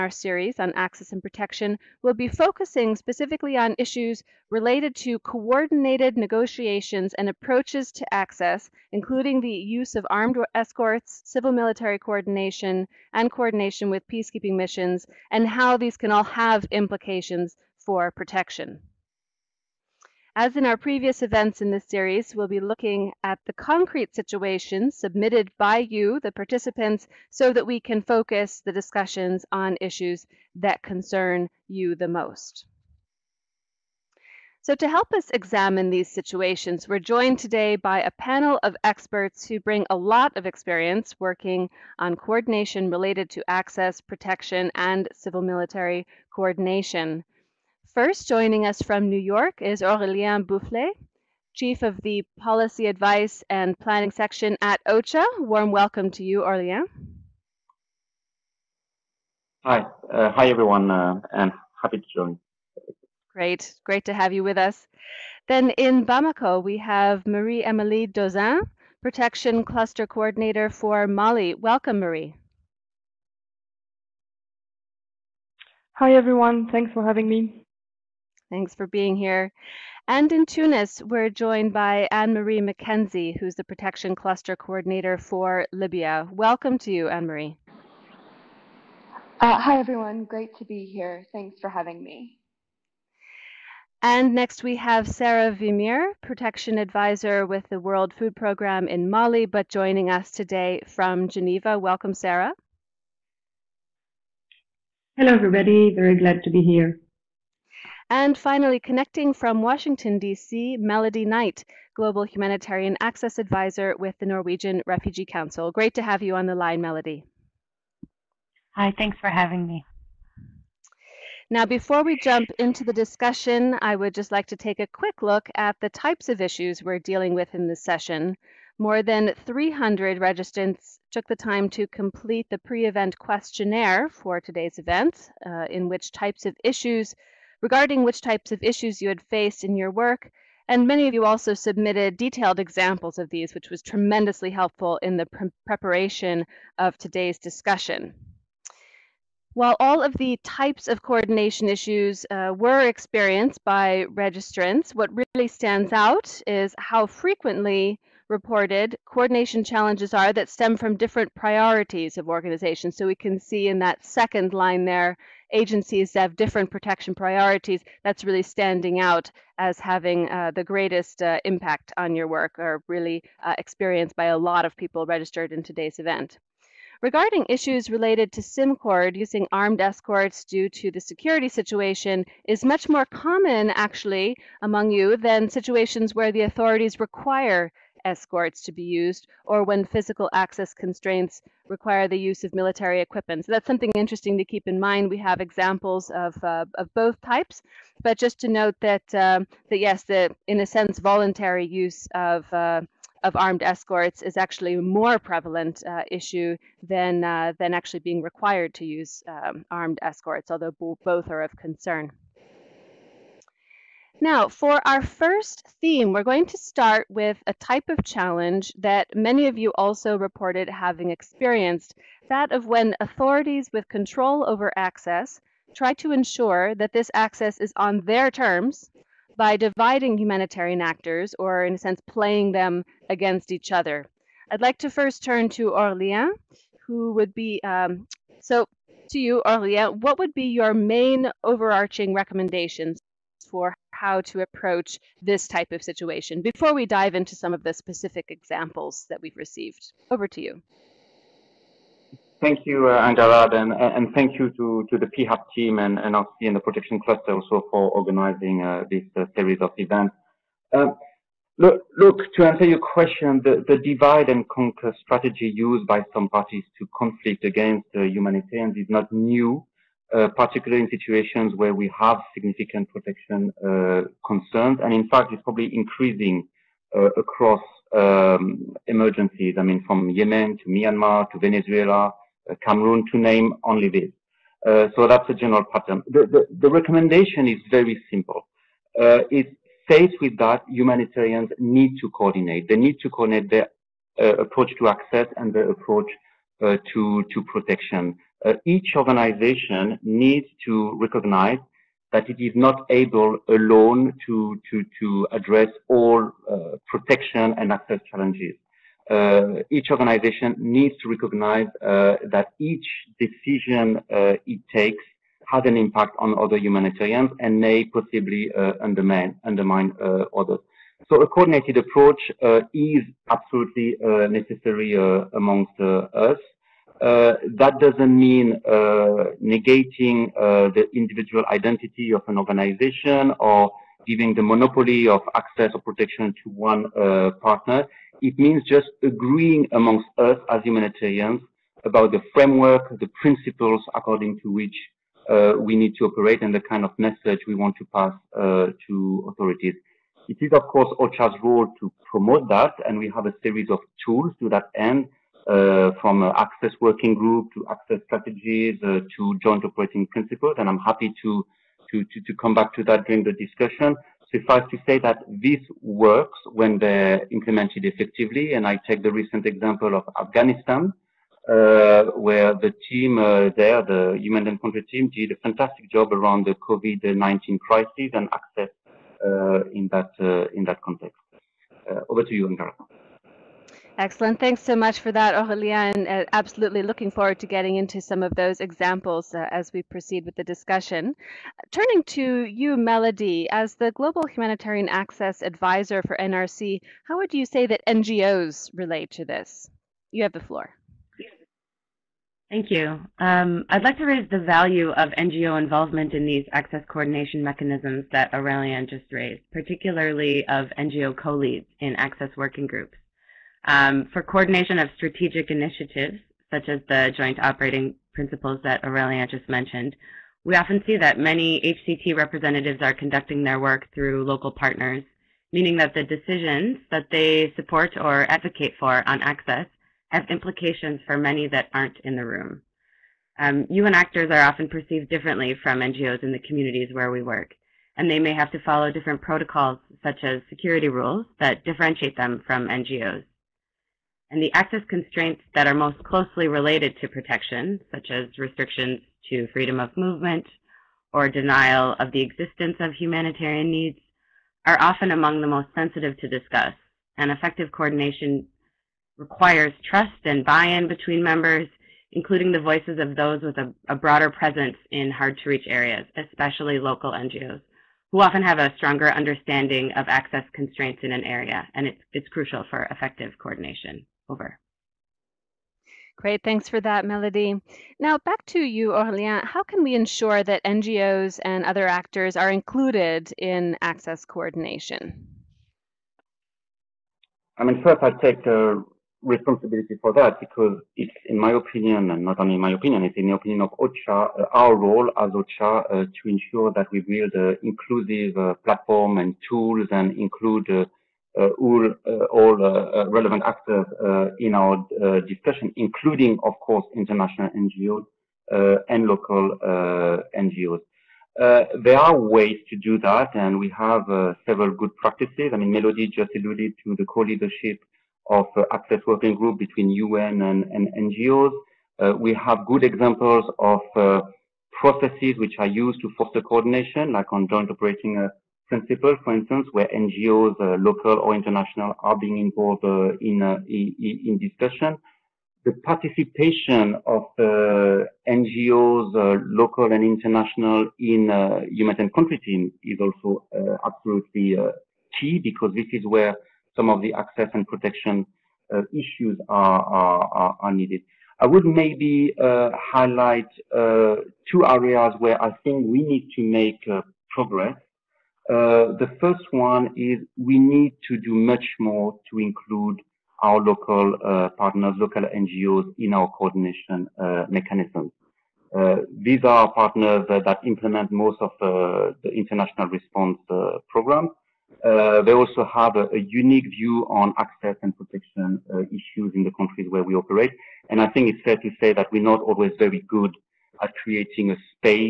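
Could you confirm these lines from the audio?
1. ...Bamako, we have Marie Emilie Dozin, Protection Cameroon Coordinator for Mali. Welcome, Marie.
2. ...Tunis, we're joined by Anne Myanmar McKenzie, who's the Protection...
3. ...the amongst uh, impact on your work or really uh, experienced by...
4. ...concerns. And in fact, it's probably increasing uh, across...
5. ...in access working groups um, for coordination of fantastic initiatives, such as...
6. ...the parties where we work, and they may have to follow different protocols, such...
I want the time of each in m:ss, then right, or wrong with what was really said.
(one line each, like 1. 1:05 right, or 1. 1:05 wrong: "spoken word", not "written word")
1. 1:06 wrong: "Cluster", not "Cameroon"
2. 1:20 wrong: "Marie", not "Myanmar"
3. 2:50 wrong: "greatest", not "amongst"
4. 4:34 right
5. 6:51 wrong: "strategic", not "fantastic"
6. 7:16 wrong: "communities", not "parties".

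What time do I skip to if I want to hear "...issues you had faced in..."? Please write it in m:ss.
2:18.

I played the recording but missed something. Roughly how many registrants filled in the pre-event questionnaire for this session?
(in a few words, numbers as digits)
More than 300.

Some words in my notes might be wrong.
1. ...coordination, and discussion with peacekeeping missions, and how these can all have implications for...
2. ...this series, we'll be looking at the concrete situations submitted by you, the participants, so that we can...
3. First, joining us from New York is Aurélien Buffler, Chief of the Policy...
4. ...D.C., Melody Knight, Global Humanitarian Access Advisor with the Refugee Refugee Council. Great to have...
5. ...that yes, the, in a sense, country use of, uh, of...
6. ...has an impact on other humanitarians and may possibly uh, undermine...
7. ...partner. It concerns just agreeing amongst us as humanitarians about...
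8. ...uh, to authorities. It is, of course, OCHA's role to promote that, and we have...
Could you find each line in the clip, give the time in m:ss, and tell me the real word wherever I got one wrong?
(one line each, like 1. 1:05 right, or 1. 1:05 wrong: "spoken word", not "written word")
1. 0:11 wrong: "coordination", not "discussion"
2. 0:21 right
3. 0:47 right
4. 1:50 wrong: "Norwegian", not "Refugee"
5. 3:19 wrong: "voluntary", not "country"
6. 5:15 right
7. 5:37 wrong: "means", not "concerns"
8. 5:48 right.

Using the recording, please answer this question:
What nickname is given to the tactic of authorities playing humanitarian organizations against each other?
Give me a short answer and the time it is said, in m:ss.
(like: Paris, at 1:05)
Divide and conquer, at 4:23.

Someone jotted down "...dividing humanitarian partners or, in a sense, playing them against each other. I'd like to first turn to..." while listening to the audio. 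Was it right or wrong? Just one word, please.
wrong.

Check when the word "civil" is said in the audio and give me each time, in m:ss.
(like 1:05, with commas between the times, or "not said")
0:11, 0:45.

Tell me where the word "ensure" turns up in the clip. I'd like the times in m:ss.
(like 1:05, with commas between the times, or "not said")
3:46, 7:59, 8:16.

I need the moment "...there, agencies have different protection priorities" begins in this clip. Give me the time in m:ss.
2:44.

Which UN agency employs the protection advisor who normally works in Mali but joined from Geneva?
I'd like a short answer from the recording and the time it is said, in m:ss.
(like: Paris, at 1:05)
World Food Programme, at 1:37.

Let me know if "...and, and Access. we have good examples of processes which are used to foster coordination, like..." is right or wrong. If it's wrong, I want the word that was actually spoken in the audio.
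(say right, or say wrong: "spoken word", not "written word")
wrong: "NGOs", not "Access".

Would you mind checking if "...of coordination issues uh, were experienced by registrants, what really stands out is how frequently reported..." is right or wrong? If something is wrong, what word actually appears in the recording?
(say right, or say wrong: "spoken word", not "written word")
right.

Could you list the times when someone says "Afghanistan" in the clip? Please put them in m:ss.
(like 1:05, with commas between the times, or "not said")
6:10.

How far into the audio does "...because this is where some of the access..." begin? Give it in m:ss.
9:05.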